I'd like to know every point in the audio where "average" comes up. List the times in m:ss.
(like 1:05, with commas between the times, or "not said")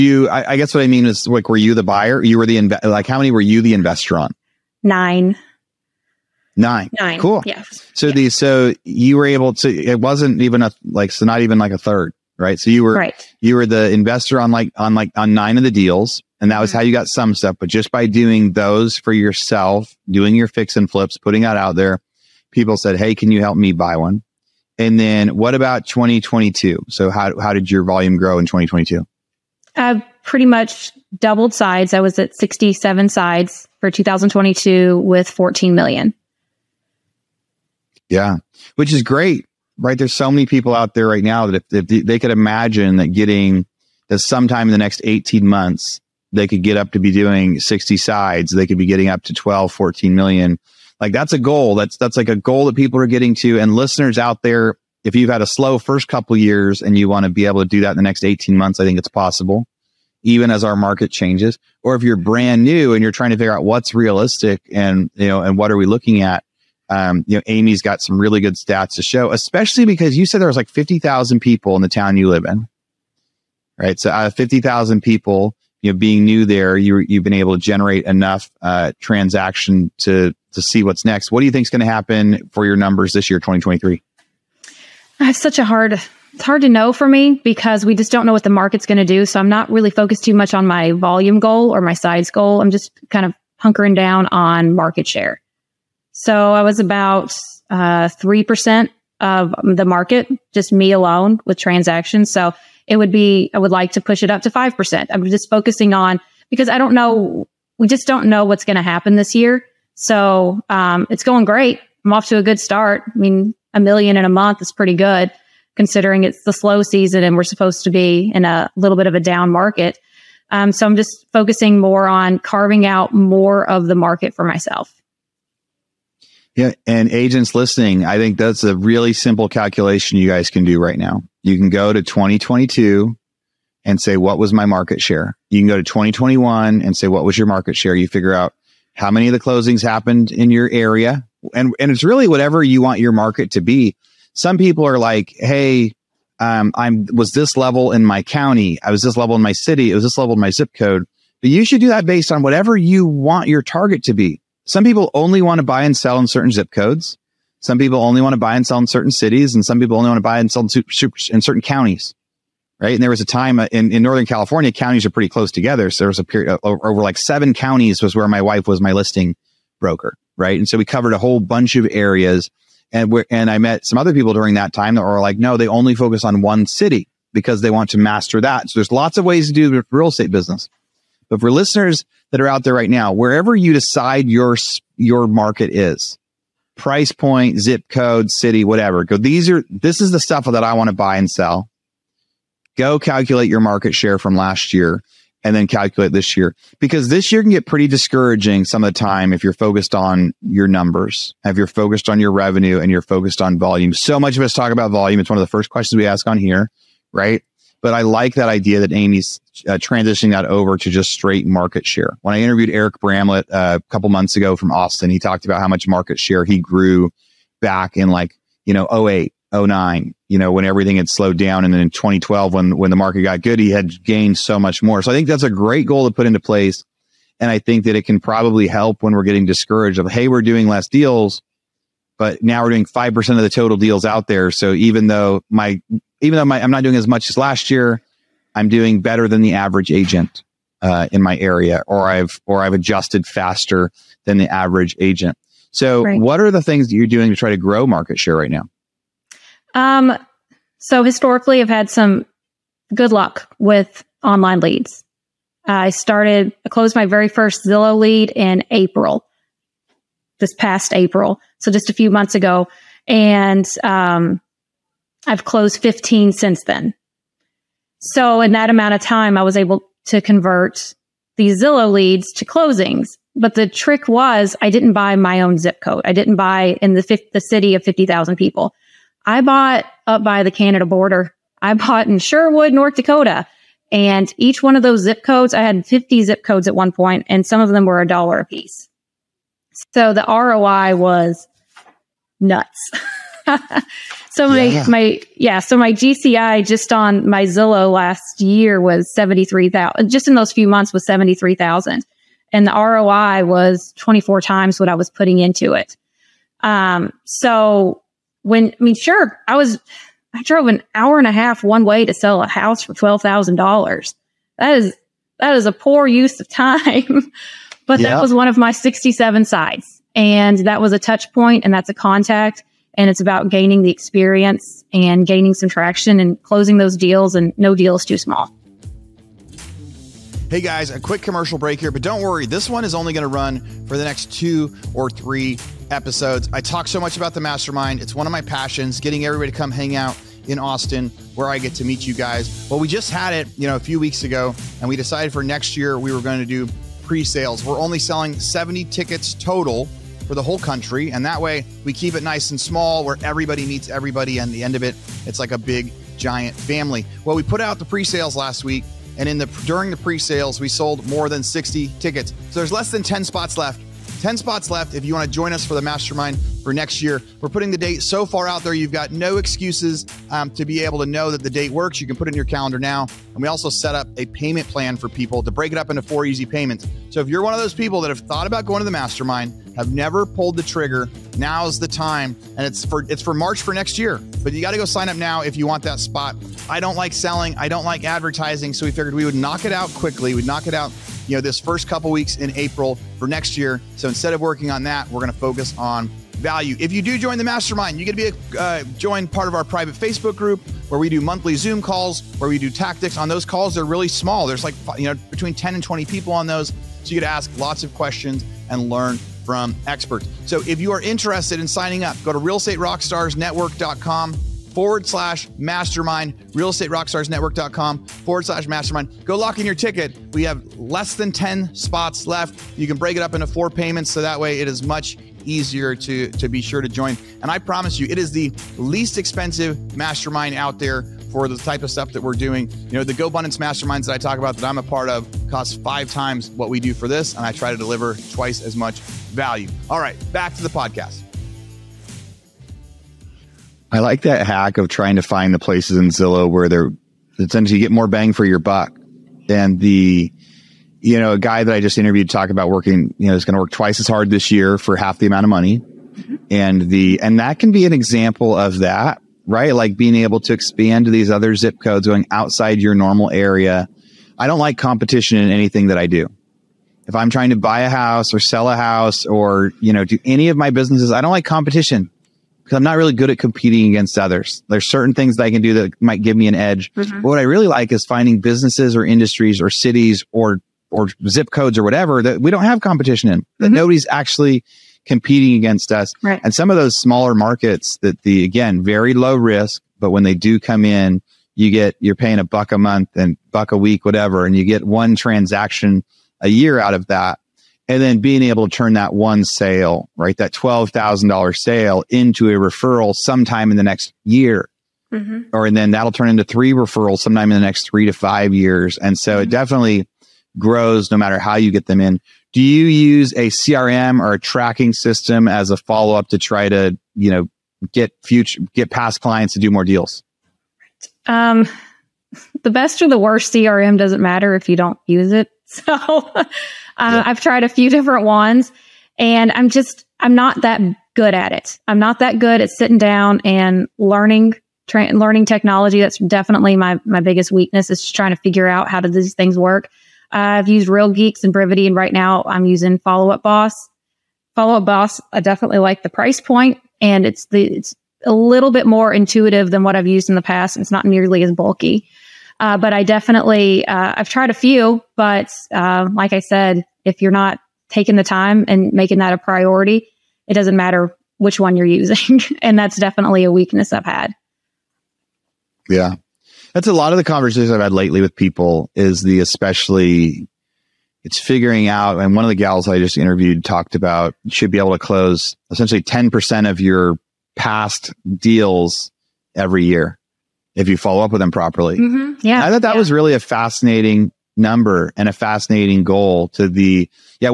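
3:59, 4:04.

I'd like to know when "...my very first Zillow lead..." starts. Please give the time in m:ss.
4:16.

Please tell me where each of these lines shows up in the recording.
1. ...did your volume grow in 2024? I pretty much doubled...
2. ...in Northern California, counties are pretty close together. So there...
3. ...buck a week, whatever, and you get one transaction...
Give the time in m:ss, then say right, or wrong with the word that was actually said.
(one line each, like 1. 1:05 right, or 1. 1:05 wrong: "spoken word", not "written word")
1. 0:27 wrong: "2022", not "2024"
2. 2:43 right
3. 8:13 right.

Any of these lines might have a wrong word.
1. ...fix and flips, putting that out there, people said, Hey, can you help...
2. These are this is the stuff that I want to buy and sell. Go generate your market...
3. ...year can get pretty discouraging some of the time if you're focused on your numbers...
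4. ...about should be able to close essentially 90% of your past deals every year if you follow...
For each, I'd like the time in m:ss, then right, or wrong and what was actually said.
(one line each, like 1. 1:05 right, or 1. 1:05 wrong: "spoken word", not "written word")
1. 0:20 right
2. 3:09 wrong: "calculate", not "generate"
3. 3:17 right
4. 9:33 wrong: "10", not "90".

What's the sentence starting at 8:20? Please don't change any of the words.
That $12,000 sale into a referral sometime in the next year.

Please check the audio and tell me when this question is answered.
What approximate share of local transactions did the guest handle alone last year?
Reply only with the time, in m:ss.
1:38.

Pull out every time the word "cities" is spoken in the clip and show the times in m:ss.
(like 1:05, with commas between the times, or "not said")
2:39, 7:59.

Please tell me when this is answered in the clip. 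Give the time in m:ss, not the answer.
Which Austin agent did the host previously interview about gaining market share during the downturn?
3:32.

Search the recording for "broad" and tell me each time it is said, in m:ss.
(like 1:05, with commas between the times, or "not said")
not said.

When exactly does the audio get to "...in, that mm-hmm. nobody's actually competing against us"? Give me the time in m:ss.
8:03.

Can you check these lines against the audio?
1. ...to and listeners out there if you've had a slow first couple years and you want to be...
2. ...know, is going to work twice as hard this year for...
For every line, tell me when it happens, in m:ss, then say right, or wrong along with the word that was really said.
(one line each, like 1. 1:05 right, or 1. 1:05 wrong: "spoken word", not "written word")
1. 0:53 right
2. 7:33 right.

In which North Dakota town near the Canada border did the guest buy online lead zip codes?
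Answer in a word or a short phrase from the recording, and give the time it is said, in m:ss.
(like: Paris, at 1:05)
Sherwood, at 4:42.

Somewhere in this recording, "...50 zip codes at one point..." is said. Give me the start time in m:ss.
4:45.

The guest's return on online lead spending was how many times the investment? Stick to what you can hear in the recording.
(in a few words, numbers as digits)
24.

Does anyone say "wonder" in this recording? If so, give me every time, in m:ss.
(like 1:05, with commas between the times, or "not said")
not said.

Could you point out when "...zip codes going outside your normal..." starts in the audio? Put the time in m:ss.
7:41.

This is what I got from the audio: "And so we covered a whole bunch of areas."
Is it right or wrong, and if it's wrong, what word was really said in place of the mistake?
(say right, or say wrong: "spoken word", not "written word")
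right.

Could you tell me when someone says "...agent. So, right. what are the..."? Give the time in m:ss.
4:05.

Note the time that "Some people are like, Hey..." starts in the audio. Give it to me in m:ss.
2:24.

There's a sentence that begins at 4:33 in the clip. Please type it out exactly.
But the trick was I didn't buy my own zip code.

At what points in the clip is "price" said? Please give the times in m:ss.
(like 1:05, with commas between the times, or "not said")
3:06, 9:06.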